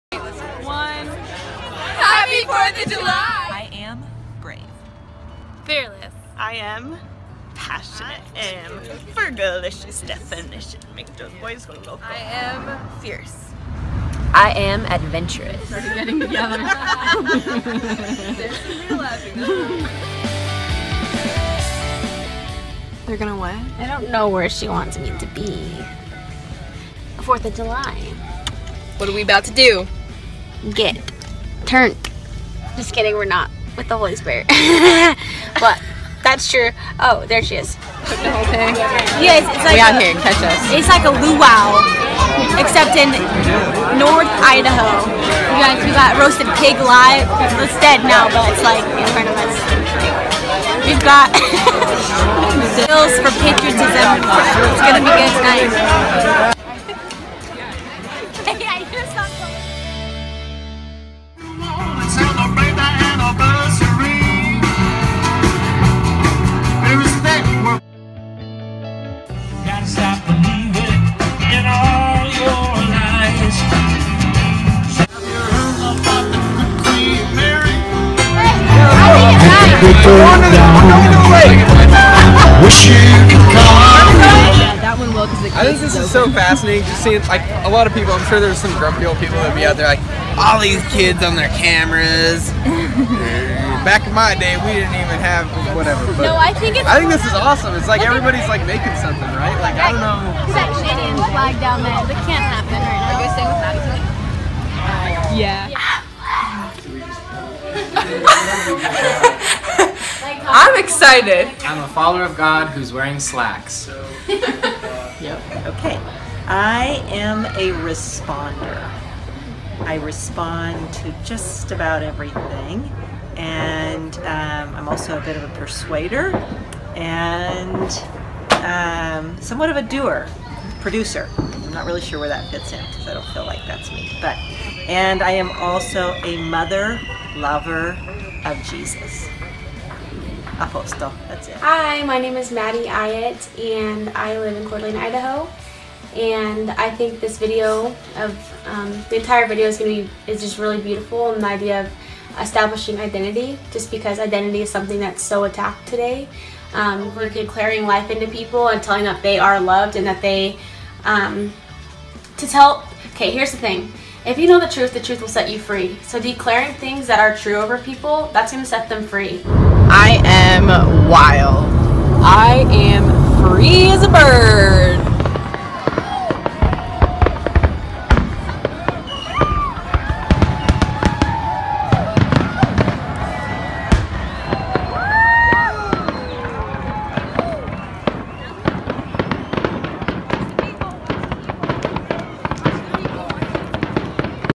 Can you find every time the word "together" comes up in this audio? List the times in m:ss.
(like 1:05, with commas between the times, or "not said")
0:16.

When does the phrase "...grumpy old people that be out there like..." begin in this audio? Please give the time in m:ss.
1:28.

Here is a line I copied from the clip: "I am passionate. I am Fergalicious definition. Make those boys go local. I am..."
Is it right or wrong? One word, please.
right.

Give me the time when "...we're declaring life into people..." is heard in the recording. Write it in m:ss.
2:37.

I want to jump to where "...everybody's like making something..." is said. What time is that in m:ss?
1:38.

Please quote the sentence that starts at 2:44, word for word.
If you know the truth, the truth will set you free.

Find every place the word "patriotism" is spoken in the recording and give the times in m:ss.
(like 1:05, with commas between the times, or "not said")
0:53.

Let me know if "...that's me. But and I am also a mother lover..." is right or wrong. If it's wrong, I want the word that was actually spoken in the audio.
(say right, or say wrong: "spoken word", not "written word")
right.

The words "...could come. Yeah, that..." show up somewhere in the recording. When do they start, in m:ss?
1:23.